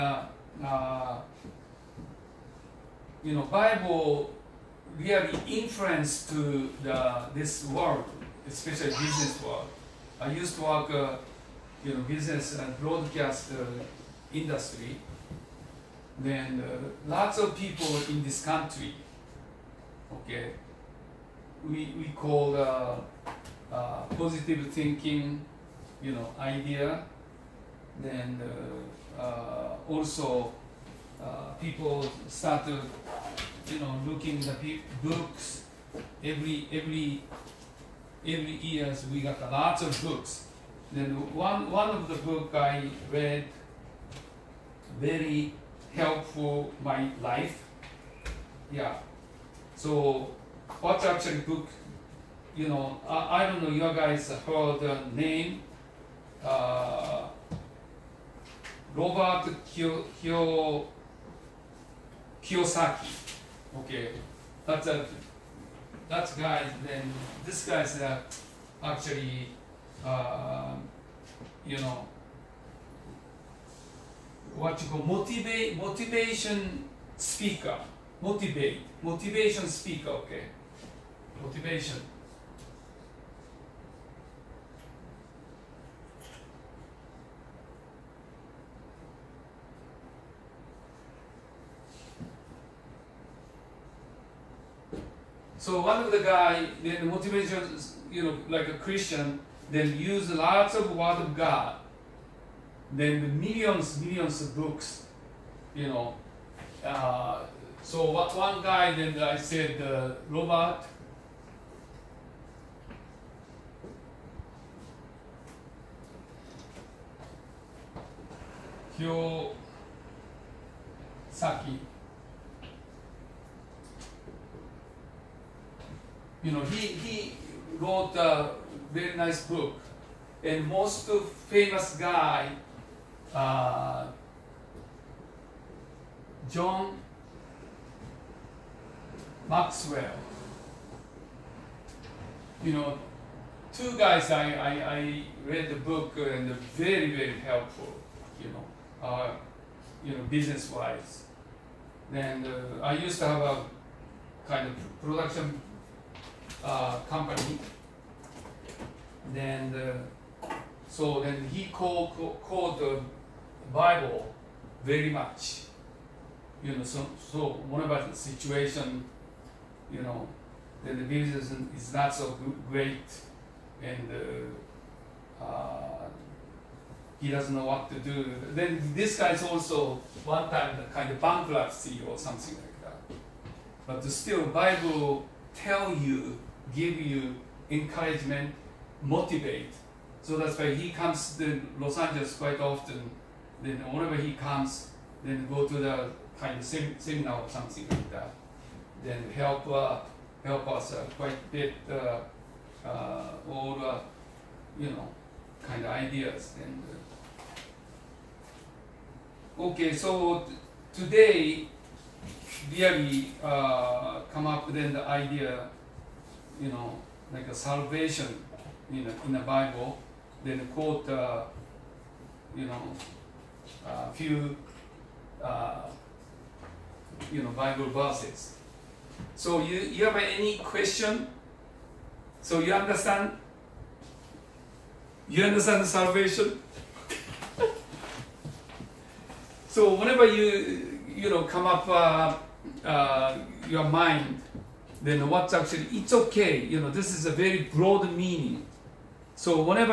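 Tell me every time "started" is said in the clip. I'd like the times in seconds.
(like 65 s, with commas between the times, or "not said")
32 s.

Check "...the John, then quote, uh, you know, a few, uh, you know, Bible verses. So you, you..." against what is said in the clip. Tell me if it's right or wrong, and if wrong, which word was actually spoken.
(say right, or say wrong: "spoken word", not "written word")
wrong: "Bible", not "John".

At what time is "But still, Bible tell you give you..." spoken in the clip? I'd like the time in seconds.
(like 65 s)
183 s.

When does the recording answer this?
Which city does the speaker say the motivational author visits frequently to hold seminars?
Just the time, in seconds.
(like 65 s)
191 s.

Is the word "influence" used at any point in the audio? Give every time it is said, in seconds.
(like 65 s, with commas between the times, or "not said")
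5 s.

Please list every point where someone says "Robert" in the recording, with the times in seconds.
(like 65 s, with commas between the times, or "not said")
58 s, 110 s.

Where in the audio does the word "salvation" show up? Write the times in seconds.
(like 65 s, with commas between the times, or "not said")
217 s, 235 s.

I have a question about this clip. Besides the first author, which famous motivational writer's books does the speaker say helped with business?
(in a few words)
John Maxwell.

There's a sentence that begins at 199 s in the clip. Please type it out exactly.
Then help uh, help us uh, quite a bit uh, uh, all the uh, you know kind of ideas and.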